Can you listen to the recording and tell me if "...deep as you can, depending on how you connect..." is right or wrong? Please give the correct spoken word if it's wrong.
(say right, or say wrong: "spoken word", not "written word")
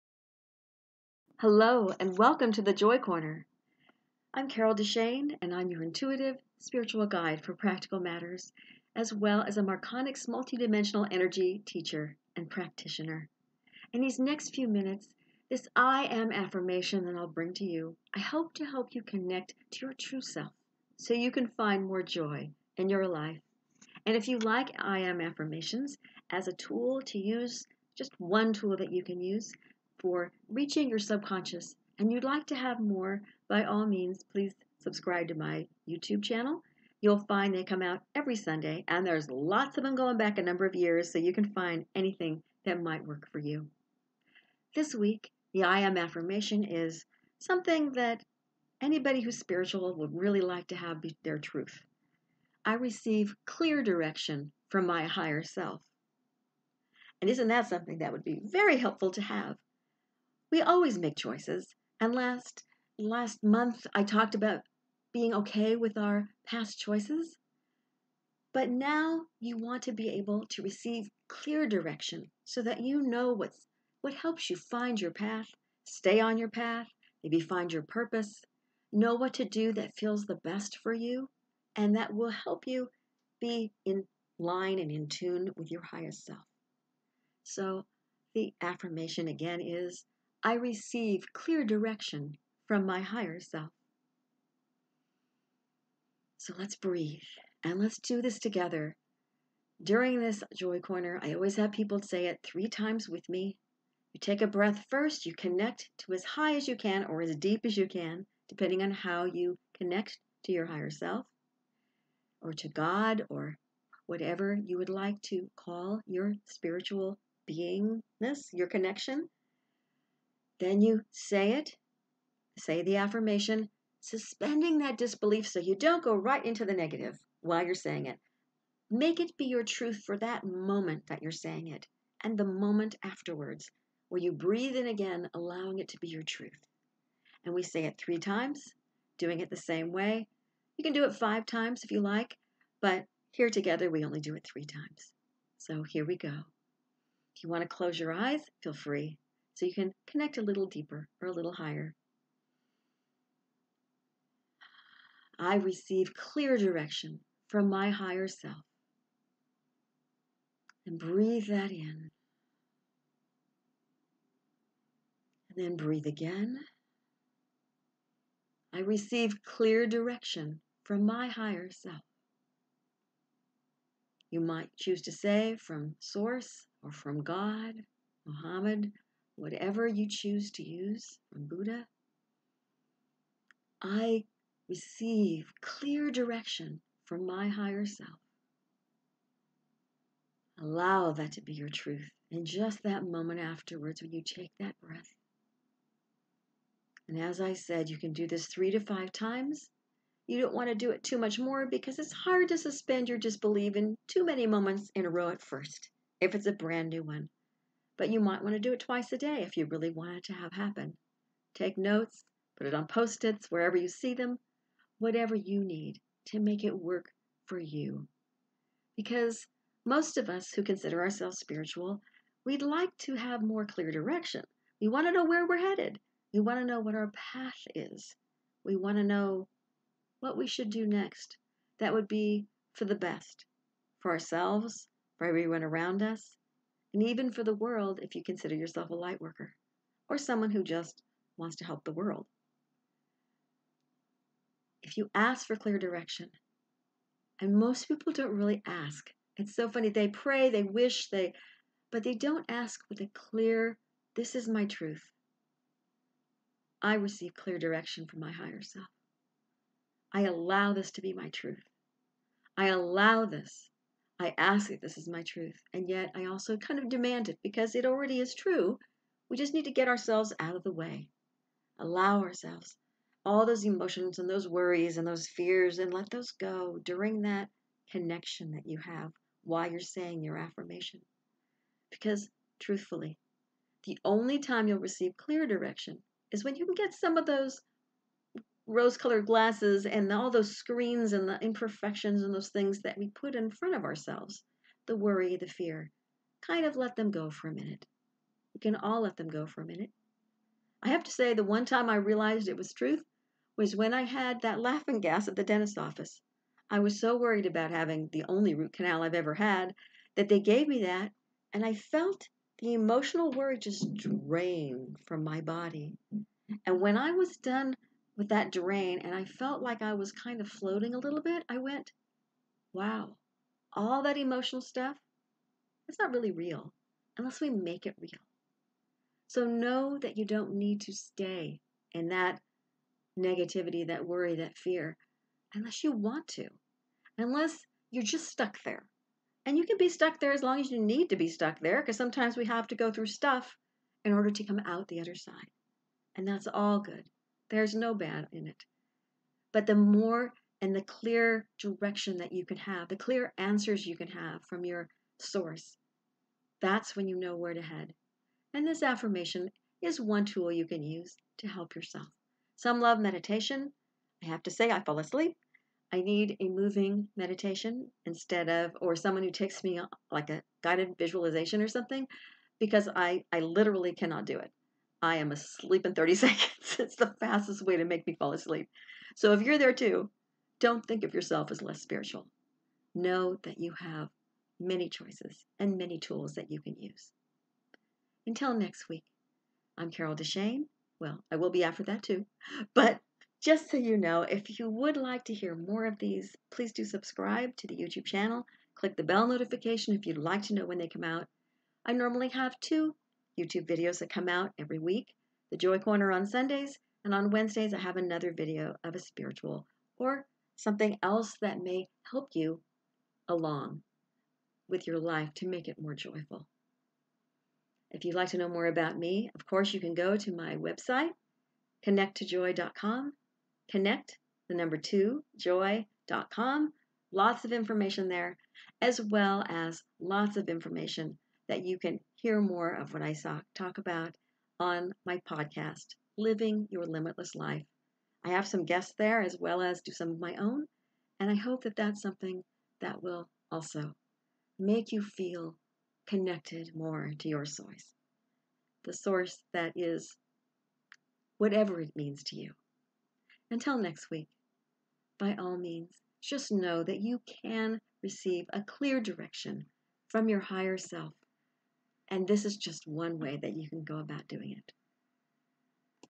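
right.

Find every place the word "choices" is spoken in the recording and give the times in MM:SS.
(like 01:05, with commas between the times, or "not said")
01:01, 01:06, 06:24.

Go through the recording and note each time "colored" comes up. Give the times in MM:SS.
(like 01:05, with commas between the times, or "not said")
04:48.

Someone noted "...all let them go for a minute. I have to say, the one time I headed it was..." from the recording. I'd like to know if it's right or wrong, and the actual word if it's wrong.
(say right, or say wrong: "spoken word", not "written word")
wrong: "realized", not "headed".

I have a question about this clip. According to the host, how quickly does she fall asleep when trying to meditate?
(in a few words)
30 seconds.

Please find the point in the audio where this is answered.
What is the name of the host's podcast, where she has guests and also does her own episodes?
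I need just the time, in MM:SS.
07:16.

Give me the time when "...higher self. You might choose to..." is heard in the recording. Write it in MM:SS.
02:51.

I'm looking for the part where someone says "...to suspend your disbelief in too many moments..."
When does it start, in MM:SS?
03:22.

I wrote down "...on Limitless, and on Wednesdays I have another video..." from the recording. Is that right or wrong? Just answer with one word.
wrong.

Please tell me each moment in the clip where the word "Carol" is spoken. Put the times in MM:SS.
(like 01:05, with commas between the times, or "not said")
00:04, 06:29.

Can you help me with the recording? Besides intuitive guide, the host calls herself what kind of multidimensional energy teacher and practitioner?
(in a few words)
Marconics.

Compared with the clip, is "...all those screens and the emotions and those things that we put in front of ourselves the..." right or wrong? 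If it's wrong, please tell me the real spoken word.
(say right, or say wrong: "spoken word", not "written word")
wrong: "imperfections", not "emotions".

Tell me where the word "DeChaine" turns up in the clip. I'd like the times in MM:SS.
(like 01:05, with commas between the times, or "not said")
00:04, 06:30.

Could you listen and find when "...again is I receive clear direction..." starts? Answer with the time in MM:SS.
01:29.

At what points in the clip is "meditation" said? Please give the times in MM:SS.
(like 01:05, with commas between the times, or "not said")
06:02, 06:07.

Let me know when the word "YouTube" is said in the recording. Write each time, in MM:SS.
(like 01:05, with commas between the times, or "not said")
00:35, 06:37, 06:43.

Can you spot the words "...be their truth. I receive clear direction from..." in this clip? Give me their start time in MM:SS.
00:50.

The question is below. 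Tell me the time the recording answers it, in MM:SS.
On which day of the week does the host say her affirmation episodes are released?
00:38.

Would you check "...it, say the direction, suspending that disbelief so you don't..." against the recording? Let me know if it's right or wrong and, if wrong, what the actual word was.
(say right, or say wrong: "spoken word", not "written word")
wrong: "affirmation", not "direction".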